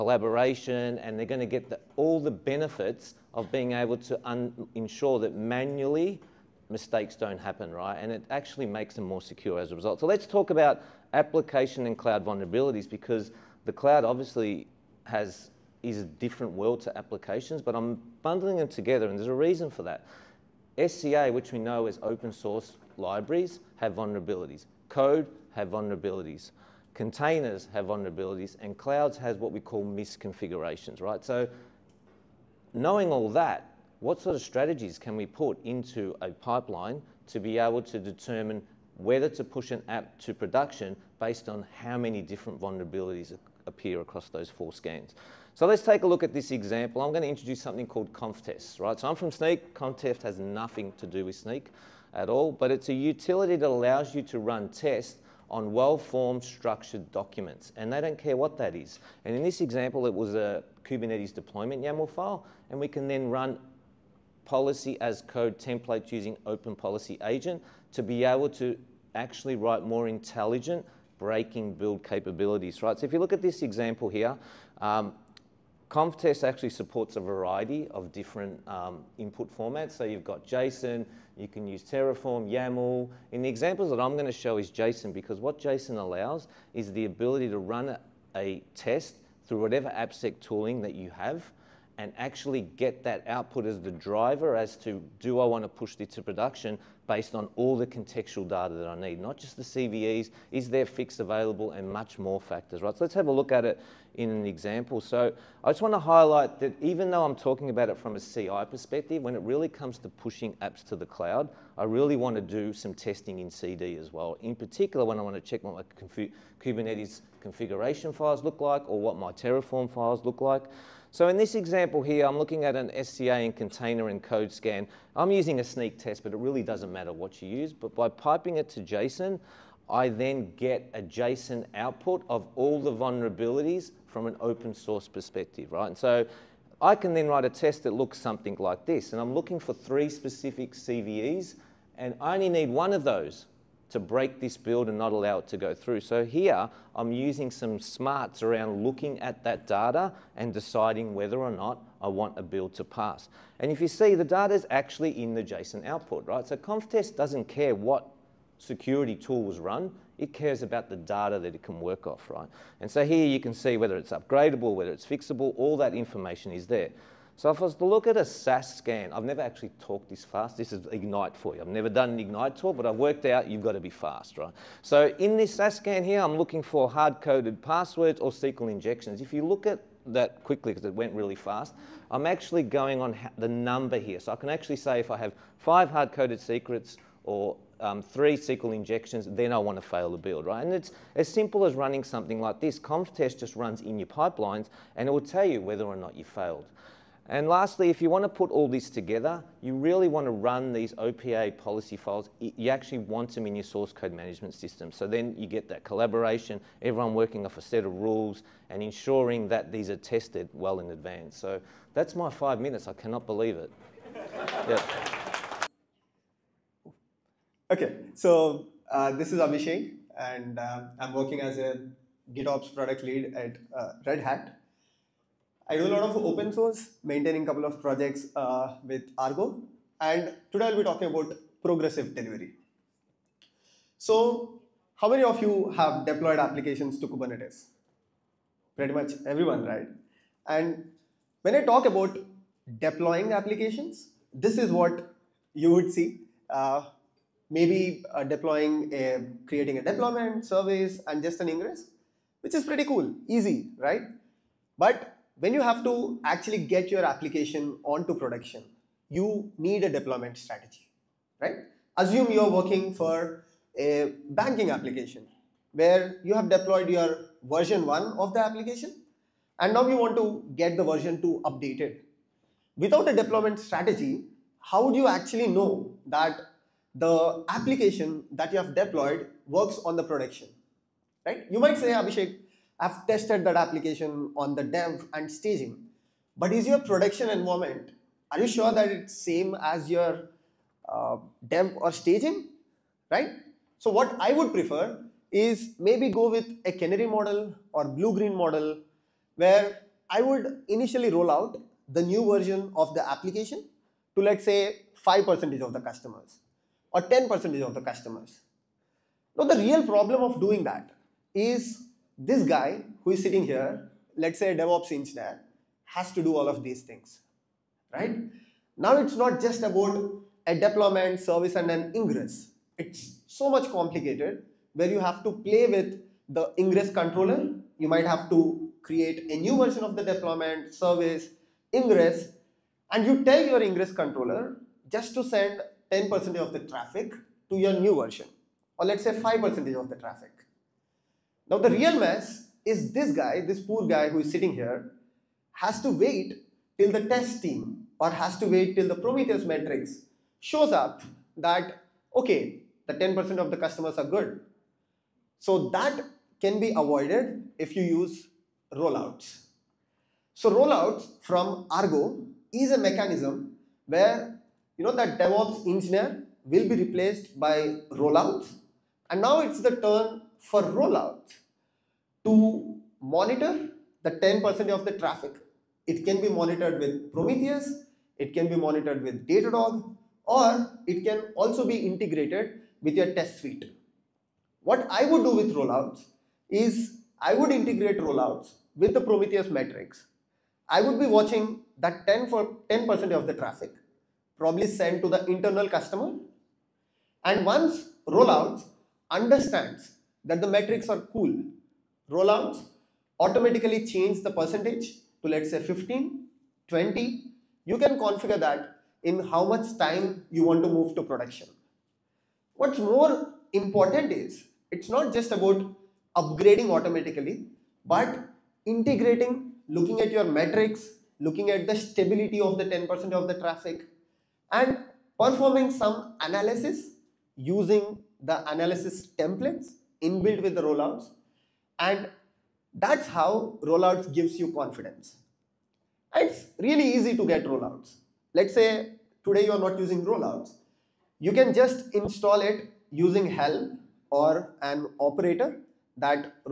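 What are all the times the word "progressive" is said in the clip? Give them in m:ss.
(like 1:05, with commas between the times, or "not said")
3:51.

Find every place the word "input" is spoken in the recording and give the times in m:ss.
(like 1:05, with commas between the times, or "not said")
1:19.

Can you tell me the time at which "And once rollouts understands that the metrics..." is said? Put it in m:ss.
6:37.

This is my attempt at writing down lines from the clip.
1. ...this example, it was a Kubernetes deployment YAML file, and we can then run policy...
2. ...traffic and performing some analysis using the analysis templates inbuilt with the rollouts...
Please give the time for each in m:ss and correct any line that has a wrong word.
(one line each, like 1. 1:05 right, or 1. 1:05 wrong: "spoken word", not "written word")
1. 0:59 right
2. 7:03 right.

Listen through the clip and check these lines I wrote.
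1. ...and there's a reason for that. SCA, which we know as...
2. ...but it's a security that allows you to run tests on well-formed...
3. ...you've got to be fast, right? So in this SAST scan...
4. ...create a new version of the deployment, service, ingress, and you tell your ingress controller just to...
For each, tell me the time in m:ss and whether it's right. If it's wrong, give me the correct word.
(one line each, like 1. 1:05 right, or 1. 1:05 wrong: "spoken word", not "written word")
1. 0:19 right
2. 0:52 wrong: "utility", not "security"
3. 2:53 right
4. 5:28 right.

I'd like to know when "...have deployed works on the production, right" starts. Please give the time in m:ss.
4:38.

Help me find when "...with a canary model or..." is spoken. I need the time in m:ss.
4:56.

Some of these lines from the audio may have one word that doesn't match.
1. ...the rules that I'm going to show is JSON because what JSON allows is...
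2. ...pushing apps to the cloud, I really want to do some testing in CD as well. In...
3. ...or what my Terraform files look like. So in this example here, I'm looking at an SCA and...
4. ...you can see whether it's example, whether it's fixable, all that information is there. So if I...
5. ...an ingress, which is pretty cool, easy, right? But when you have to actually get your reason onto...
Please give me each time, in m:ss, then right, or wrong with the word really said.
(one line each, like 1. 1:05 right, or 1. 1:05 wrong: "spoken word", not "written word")
1. 1:23 wrong: "examples", not "rules"
2. 1:50 right
3. 1:58 right
4. 2:43 wrong: "upgradable", not "example"
5. 4:11 wrong: "application", not "reason".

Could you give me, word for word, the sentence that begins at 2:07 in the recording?
But by piping it to JSON, I then get a JSON output of all the vulnerabilities from an open source perspective, right?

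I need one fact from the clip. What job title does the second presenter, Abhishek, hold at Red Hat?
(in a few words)
GitOps product lead.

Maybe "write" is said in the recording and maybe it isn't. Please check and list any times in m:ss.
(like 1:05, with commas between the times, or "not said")
1:09, 2:17.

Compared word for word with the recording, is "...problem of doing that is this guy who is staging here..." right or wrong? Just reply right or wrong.
wrong.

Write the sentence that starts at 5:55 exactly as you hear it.
So that can be avoided if you use rollouts.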